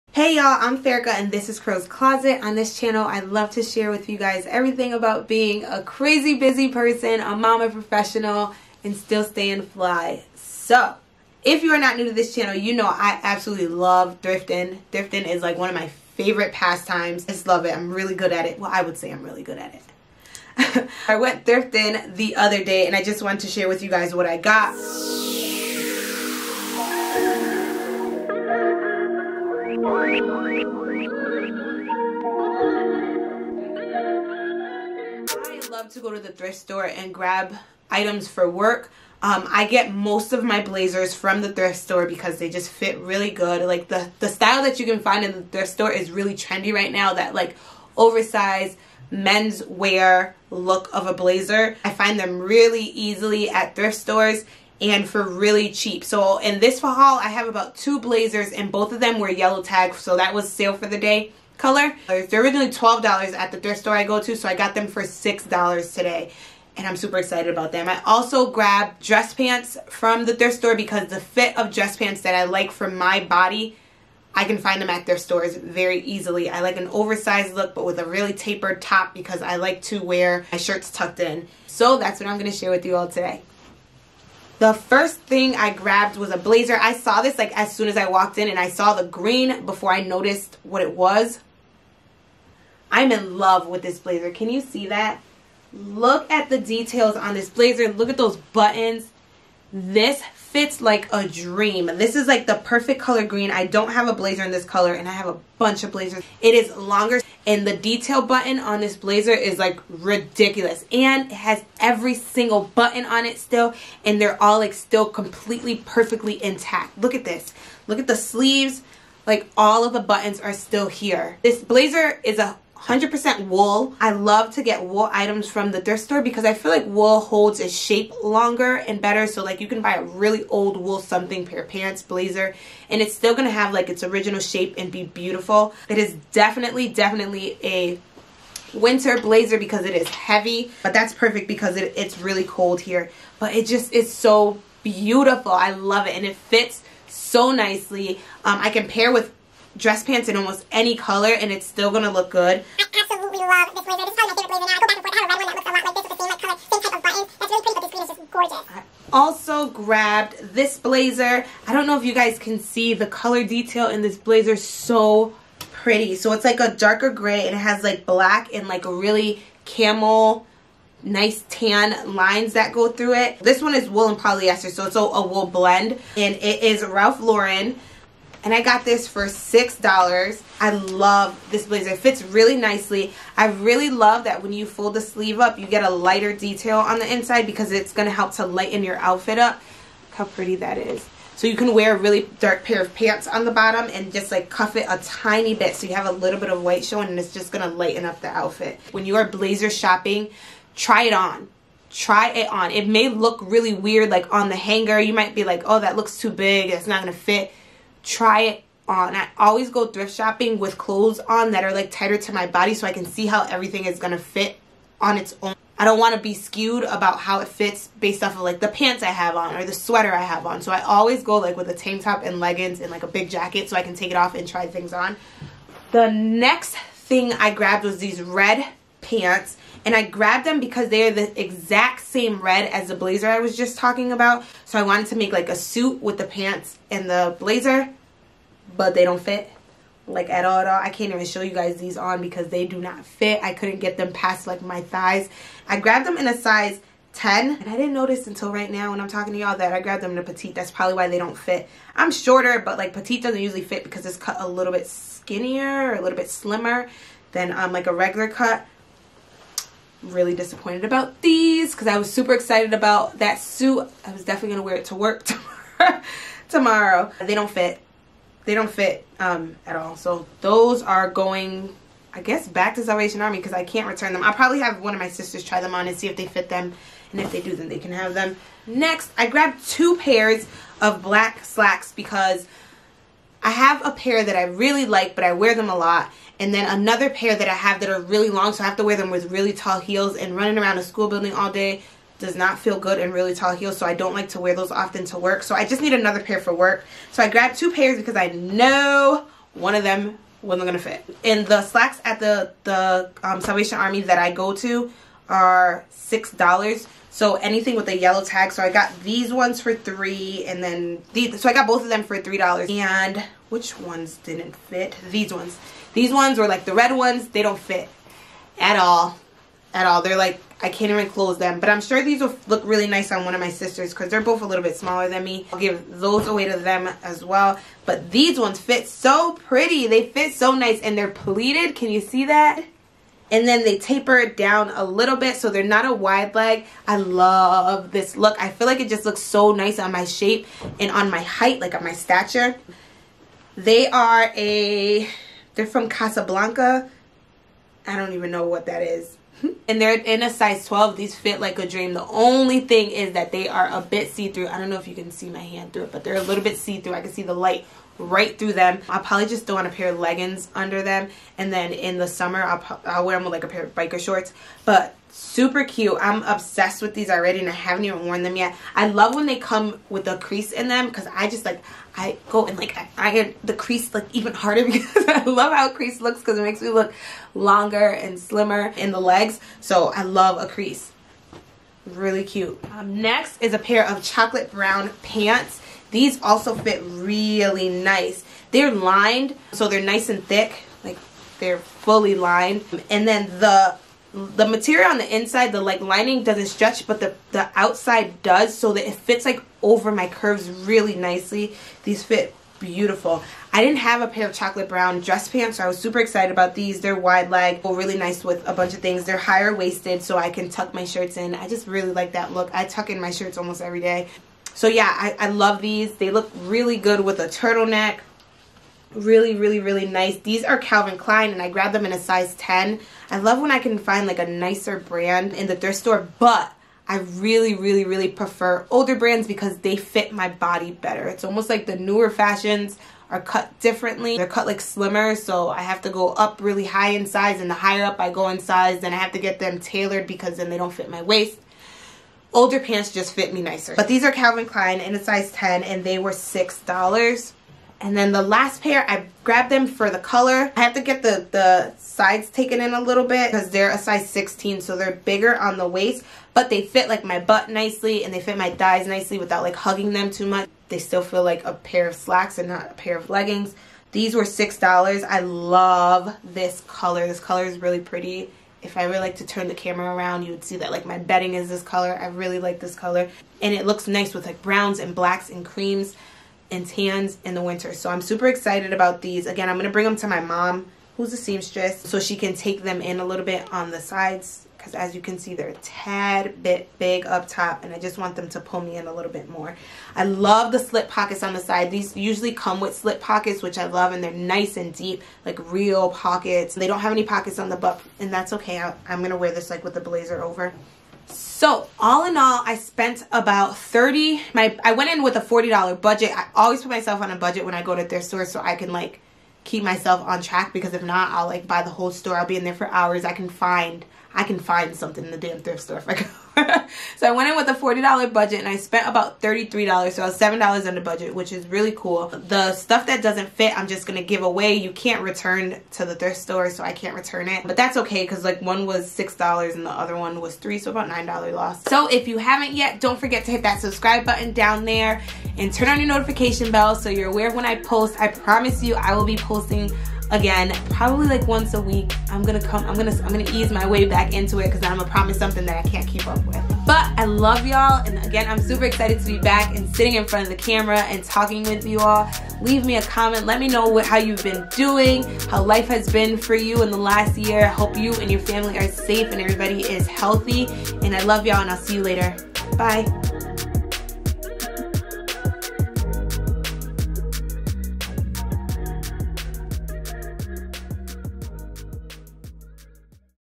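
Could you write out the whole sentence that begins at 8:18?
I, am going to wear this like with the blazer over.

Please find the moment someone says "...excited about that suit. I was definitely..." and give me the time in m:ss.
4:22.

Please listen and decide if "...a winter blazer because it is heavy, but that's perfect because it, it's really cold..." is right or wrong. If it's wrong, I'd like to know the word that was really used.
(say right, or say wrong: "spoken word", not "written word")
right.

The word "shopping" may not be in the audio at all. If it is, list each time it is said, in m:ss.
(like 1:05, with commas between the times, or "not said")
3:19, 3:30.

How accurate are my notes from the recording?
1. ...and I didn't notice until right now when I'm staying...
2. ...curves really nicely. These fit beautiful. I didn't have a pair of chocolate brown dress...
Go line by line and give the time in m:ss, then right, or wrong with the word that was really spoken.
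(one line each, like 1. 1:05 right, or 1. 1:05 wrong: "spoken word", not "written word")
1. 4:07 wrong: "talking", not "staying"
2. 6:40 right.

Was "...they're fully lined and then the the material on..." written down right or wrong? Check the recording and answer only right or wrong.
right.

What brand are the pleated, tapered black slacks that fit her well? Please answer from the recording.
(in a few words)
Casablanca.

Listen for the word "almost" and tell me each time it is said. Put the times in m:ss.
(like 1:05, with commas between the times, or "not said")
2:30, 6:53, 7:11.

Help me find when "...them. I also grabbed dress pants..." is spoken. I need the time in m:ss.
1:07.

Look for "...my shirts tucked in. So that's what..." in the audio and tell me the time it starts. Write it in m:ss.
1:20.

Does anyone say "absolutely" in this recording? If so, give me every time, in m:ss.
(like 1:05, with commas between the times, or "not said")
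0:13, 2:32.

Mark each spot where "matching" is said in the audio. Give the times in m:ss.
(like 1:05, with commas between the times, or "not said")
not said.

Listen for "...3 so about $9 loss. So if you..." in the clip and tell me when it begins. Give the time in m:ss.
8:50.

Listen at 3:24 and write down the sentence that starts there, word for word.
You might be like, oh, that looks too big.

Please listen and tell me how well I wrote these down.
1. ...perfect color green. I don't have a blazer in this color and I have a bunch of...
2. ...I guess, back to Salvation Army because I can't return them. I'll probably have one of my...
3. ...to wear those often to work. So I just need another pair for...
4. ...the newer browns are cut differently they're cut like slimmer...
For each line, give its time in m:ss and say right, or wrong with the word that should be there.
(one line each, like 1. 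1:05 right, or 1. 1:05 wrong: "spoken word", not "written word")
1. 1:42 right
2. 4:32 right
3. 4:54 right
4. 7:11 wrong: "fashions", not "browns".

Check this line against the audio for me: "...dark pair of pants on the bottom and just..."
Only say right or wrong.
right.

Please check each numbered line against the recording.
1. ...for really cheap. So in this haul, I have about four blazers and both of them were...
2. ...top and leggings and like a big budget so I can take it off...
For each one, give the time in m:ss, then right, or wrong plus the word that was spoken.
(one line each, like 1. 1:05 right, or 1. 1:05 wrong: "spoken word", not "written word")
1. 0:55 wrong: "two", not "four"
2. 3:42 wrong: "jacket", not "budget".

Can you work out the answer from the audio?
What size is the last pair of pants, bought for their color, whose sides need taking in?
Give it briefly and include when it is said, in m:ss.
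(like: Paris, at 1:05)
16, at 7:34.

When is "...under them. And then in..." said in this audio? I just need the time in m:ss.
6:00.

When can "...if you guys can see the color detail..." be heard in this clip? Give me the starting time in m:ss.
2:41.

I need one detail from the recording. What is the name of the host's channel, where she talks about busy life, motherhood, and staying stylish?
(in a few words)
Crow's Closet.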